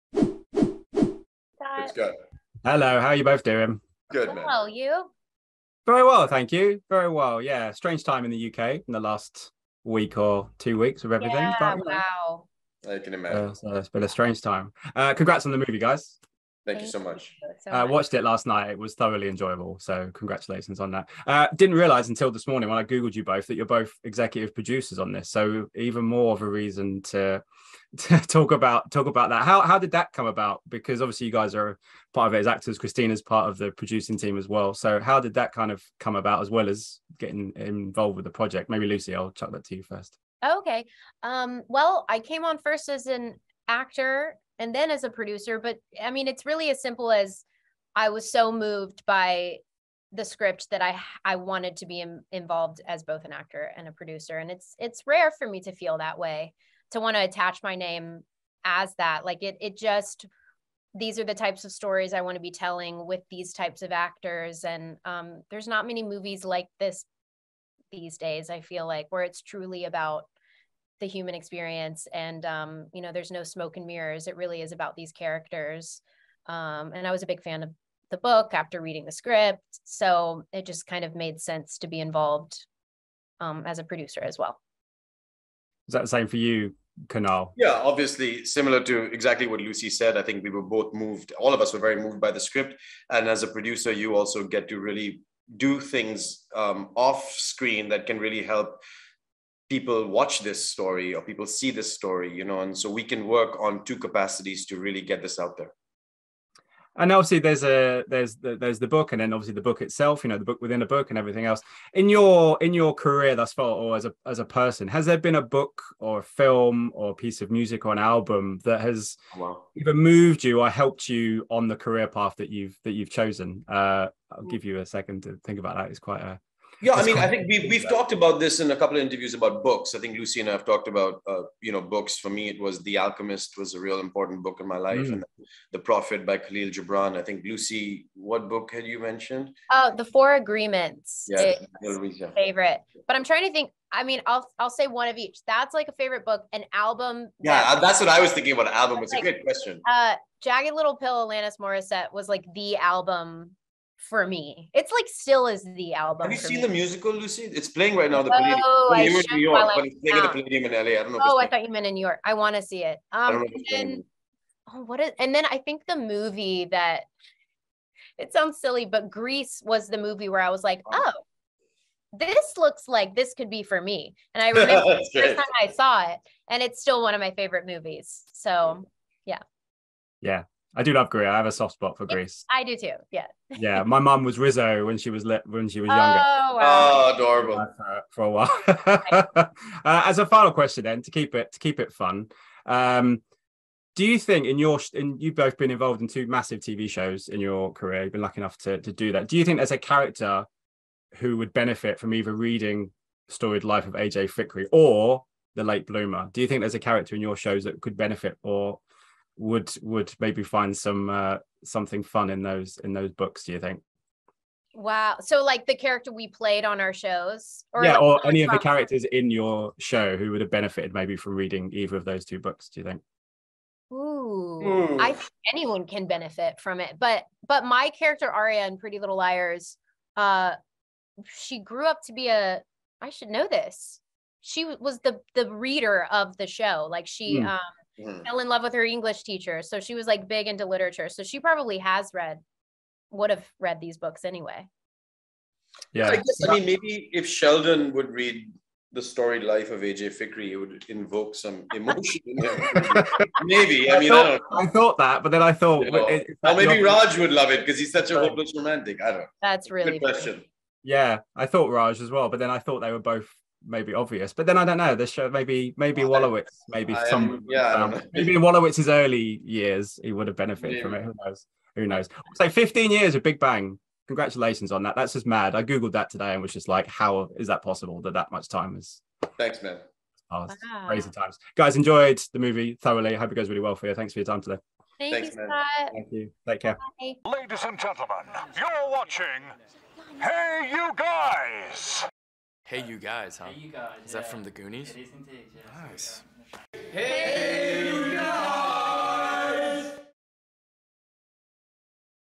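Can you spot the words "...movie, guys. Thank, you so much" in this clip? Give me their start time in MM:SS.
00:15.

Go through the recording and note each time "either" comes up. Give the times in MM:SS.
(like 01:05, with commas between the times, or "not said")
01:59, 03:22, 03:41.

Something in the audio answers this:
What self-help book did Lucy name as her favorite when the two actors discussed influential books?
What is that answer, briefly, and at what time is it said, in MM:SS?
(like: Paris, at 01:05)
The Four Agreements, at 02:19.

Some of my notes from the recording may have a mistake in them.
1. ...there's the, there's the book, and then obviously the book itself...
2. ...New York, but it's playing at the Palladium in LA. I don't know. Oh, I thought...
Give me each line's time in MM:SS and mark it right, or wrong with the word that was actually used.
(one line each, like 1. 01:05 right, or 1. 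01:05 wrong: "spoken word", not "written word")
1. 01:48 right
2. 02:39 right.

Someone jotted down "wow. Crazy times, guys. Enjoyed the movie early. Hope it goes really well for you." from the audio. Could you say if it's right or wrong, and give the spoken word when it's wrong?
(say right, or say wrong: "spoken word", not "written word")
wrong: "thoroughly", not "early".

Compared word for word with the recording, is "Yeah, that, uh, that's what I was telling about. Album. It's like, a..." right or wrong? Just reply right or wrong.
wrong.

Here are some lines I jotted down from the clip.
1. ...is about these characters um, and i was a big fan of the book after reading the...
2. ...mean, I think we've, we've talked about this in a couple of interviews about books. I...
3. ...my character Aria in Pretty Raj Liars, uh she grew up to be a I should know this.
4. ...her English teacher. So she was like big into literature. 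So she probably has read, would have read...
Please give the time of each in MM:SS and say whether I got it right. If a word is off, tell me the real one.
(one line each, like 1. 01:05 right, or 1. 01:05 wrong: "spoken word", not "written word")
1. 01:14 right
2. 02:07 right
3. 03:47 wrong: "Little", not "Raj"
4. 03:58 right.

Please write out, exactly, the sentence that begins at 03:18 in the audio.
You've been lucky enough to to do that.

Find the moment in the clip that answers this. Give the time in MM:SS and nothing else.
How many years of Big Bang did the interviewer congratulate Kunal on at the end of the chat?
04:32.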